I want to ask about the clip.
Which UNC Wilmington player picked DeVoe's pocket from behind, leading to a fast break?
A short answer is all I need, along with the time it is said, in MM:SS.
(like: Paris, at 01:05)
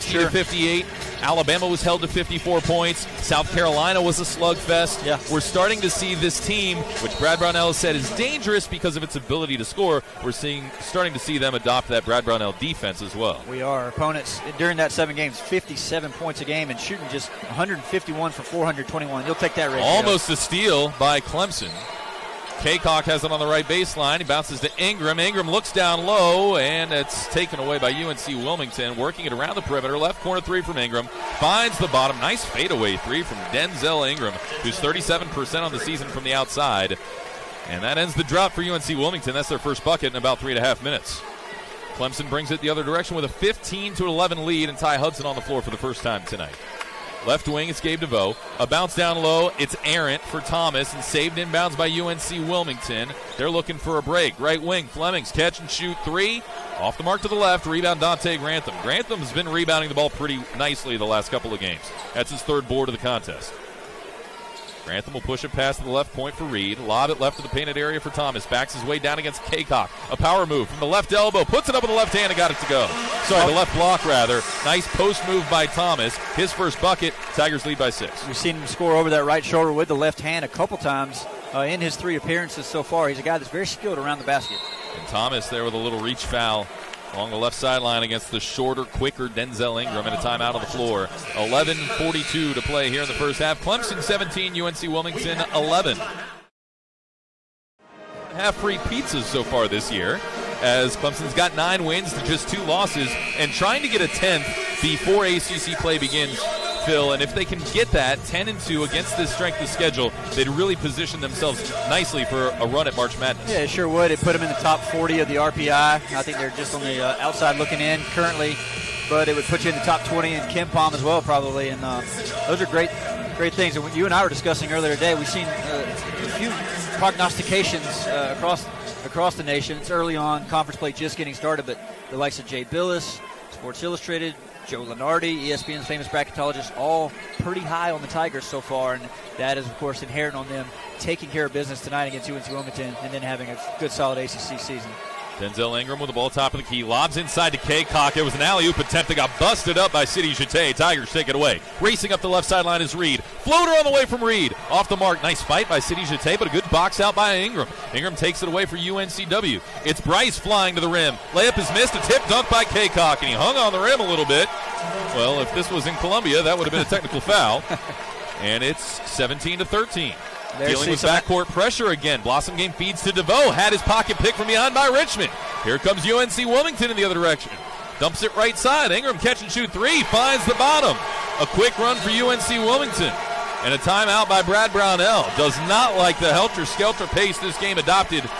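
Richmond, at 02:54.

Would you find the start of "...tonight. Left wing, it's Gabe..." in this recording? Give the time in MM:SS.
00:46.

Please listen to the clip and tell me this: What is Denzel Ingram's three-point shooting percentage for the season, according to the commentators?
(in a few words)
37%.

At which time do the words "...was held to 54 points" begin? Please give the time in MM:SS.
00:01.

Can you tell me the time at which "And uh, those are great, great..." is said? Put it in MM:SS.
02:01.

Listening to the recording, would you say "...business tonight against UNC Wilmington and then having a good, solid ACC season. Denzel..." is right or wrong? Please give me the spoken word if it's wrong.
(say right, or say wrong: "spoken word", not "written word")
right.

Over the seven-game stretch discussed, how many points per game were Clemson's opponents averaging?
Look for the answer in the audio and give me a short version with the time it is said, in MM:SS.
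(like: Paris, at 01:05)
57, at 00:15.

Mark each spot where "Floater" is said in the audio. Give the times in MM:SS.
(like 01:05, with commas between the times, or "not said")
02:33.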